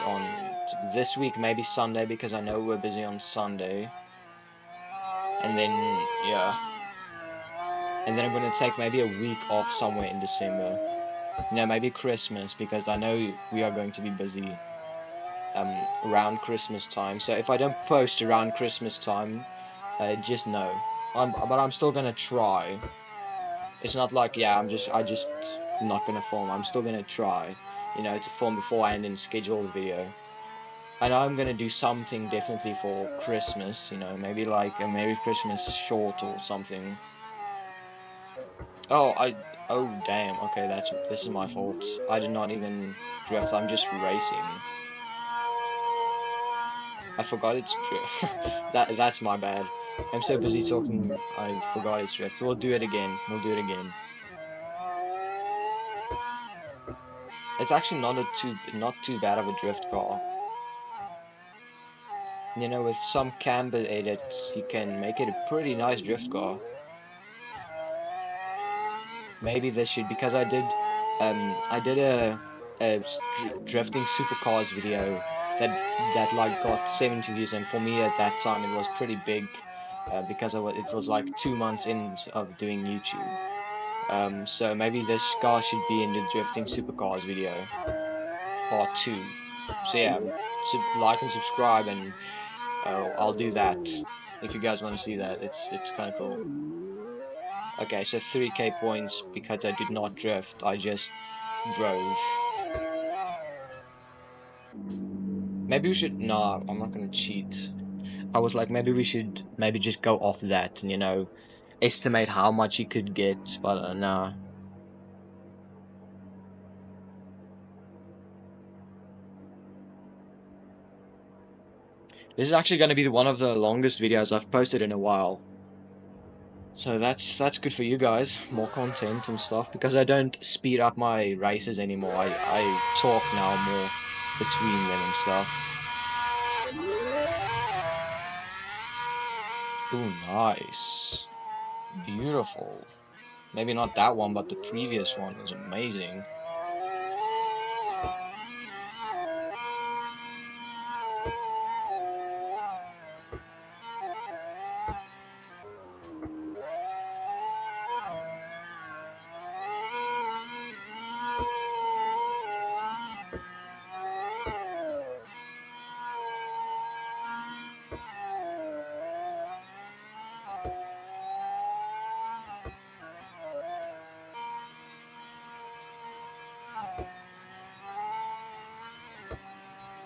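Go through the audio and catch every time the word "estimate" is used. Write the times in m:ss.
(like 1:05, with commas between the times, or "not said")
1:51.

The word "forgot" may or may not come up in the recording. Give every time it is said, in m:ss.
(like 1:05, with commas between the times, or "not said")
0:47, 0:51.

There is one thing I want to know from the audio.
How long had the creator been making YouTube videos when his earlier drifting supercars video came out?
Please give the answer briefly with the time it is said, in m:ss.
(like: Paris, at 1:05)
two months, at 1:21.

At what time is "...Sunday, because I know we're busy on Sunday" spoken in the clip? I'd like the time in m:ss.
0:01.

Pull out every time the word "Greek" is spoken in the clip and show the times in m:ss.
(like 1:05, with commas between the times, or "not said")
not said.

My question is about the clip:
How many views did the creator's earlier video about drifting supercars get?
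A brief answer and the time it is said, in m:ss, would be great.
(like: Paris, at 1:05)
70, at 1:16.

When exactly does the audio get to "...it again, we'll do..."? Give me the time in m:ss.
0:52.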